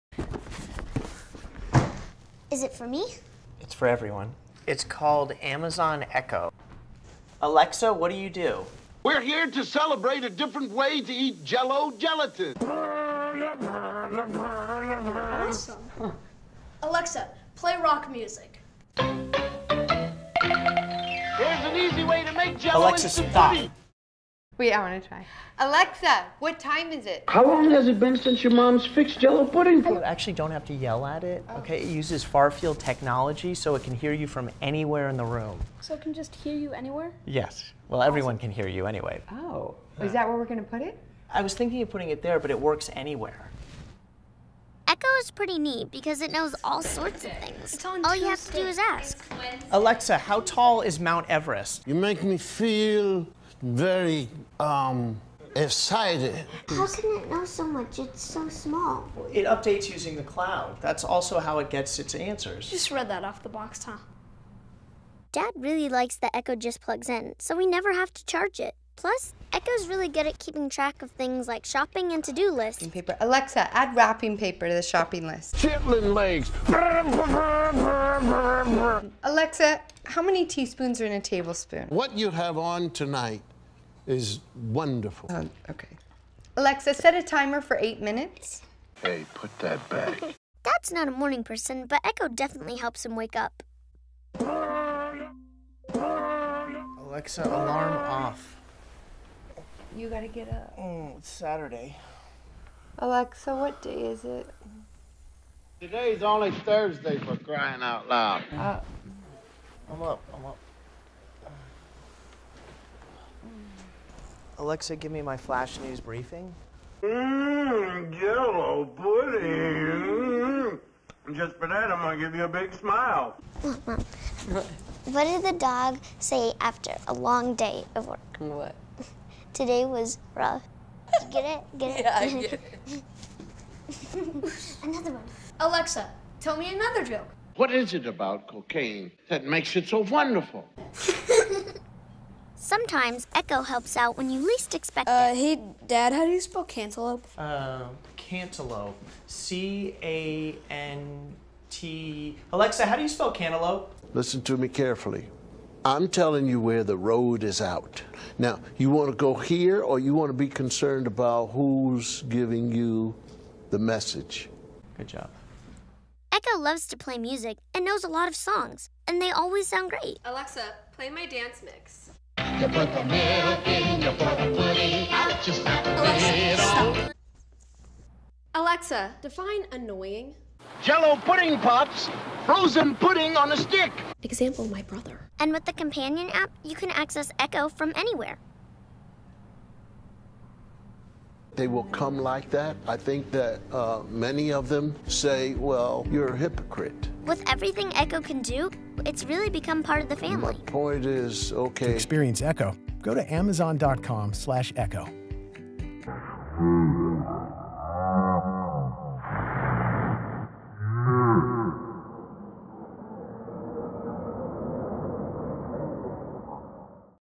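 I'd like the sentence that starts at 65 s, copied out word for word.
Dad really likes that Echo just plugs in, so we never have to charge it.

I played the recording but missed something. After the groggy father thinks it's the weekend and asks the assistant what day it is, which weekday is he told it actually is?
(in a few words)
Thursday.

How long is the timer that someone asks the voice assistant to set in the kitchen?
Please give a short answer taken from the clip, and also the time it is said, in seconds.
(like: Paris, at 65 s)
8 minutes, at 87 s.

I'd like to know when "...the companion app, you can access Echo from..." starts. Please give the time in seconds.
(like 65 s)
185 s.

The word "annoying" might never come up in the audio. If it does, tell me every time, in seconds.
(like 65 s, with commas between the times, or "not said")
179 s.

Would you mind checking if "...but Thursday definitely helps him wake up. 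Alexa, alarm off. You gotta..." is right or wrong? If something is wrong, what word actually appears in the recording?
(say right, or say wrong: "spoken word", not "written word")
wrong: "Echo", not "Thursday".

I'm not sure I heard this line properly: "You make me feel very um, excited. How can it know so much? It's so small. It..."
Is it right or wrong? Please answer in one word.
right.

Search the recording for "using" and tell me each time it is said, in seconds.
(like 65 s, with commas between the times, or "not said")
59 s.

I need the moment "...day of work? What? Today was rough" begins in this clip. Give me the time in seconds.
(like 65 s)
127 s.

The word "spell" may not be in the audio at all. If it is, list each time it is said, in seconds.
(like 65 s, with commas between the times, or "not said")
146 s, 153 s.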